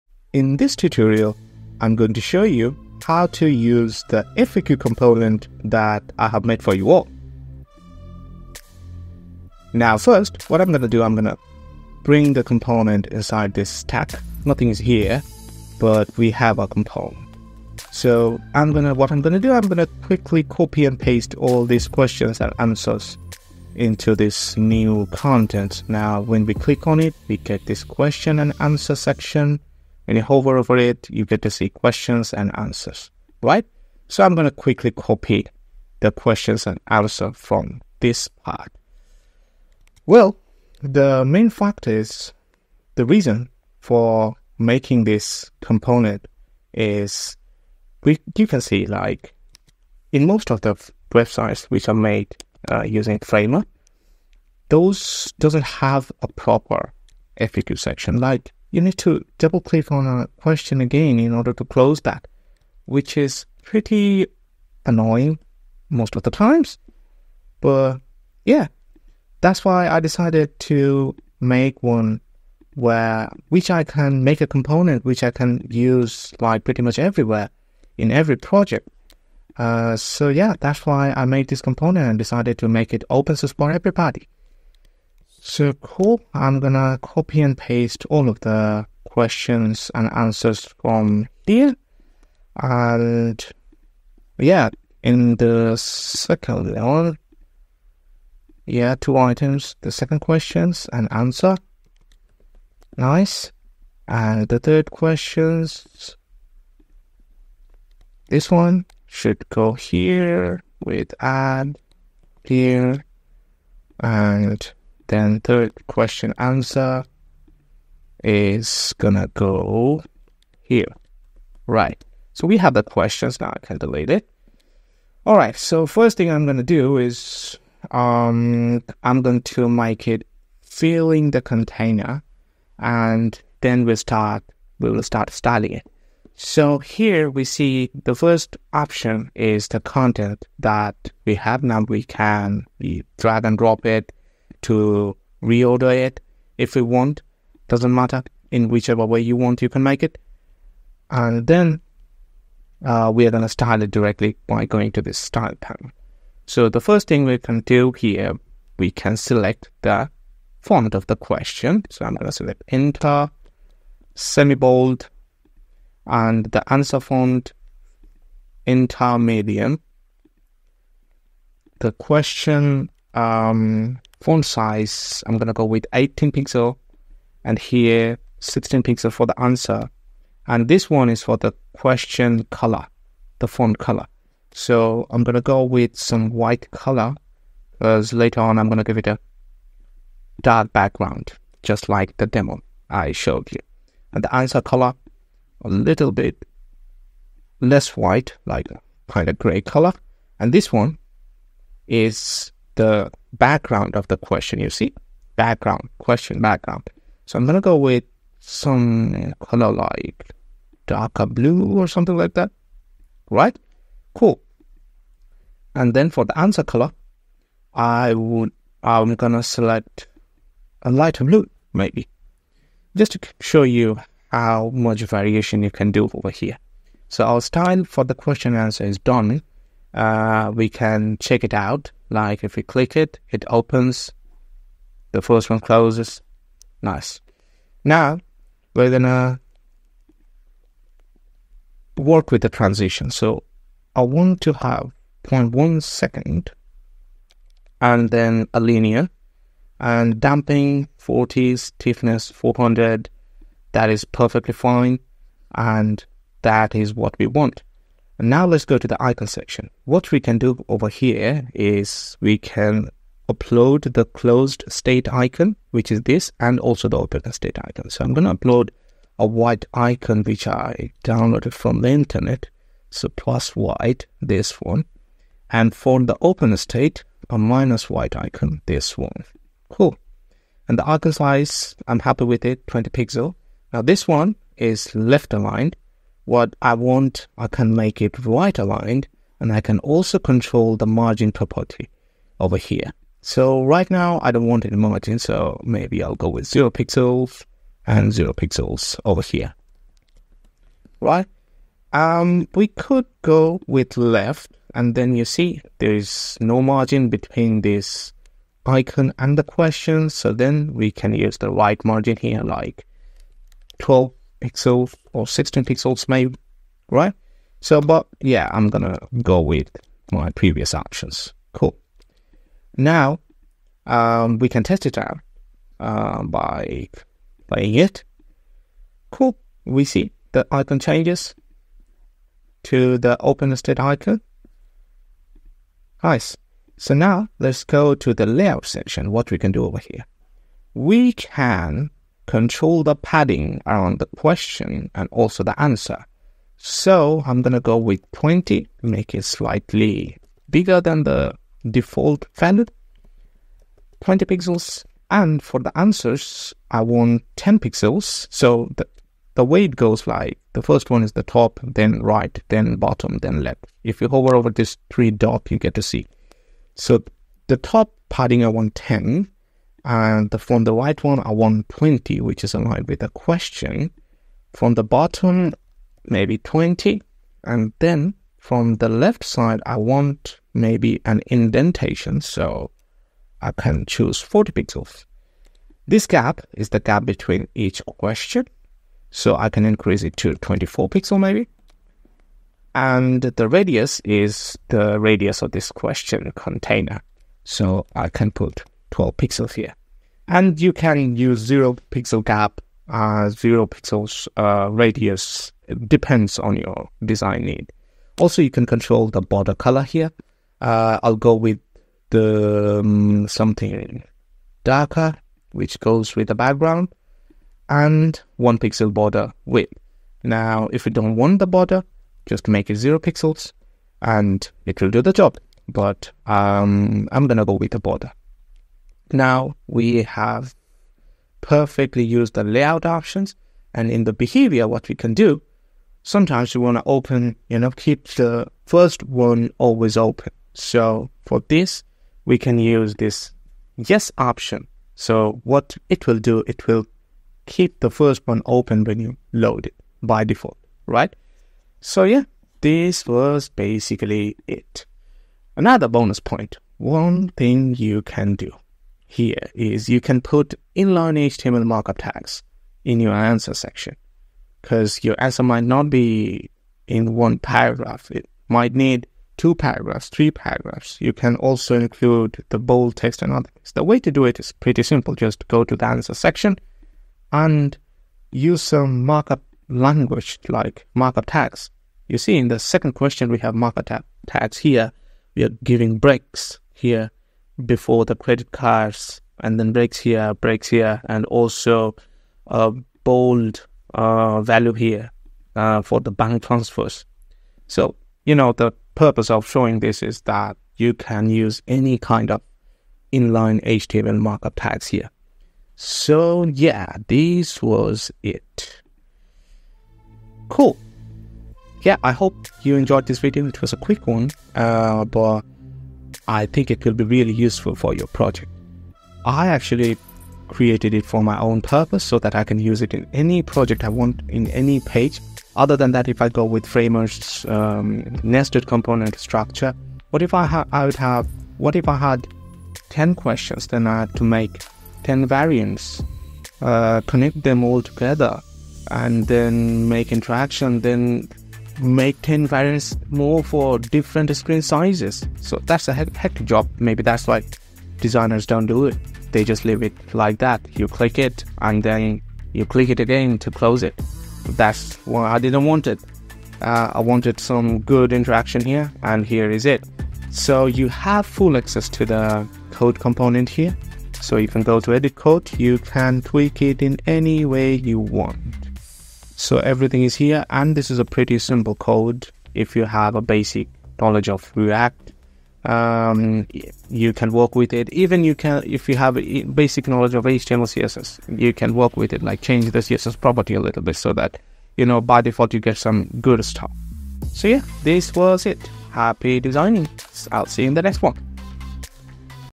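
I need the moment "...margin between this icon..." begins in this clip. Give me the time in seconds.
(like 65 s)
306 s.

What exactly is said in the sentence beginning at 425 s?
But um, I'm gonna go with the border.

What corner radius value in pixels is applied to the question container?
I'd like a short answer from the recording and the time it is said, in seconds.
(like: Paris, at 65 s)
12 pixels, at 398 s.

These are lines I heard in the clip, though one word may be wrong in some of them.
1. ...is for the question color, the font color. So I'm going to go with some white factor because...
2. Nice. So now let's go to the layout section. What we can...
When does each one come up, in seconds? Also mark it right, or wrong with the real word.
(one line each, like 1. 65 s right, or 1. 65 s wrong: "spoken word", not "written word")
1. 181 s wrong: "color", not "factor"
2. 336 s right.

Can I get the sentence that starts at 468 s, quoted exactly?
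It might need two paragraphs, three paragraphs.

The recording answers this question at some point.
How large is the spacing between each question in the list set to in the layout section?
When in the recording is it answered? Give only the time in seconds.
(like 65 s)
390 s.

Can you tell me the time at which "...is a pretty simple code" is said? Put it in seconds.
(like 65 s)
570 s.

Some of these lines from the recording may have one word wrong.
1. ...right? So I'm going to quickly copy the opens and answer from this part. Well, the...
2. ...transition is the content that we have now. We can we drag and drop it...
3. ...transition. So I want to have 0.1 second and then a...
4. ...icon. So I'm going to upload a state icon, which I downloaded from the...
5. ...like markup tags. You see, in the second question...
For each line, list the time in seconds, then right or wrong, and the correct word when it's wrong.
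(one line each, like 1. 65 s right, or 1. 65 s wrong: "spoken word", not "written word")
1. 33 s wrong: "questions", not "opens"
2. 138 s wrong: "option", not "transition"
3. 242 s right
4. 267 s wrong: "white", not "state"
5. 480 s right.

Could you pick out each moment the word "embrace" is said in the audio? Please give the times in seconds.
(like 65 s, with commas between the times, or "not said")
not said.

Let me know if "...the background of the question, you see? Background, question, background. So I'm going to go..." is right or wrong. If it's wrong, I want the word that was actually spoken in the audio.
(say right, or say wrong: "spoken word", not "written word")
right.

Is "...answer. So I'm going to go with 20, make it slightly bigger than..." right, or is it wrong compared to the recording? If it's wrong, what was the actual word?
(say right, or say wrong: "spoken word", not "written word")
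right.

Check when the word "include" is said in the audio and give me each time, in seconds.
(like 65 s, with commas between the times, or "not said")
471 s.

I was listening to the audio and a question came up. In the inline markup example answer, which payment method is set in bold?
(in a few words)
bank transfers.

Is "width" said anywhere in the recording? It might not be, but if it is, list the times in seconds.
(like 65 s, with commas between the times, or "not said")
419 s.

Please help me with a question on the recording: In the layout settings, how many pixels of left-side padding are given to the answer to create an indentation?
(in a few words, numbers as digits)
40 pixels.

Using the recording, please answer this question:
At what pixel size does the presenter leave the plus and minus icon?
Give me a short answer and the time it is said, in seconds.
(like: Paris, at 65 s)
20 pixels, at 282 s.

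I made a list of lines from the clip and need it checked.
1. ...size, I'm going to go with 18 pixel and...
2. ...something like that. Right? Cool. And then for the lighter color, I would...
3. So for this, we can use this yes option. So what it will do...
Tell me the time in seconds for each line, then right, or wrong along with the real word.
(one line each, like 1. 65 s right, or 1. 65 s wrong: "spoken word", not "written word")
1. 174 s right
2. 211 s wrong: "answer", not "lighter"
3. 440 s right.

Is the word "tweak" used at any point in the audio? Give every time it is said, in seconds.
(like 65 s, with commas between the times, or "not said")
566 s.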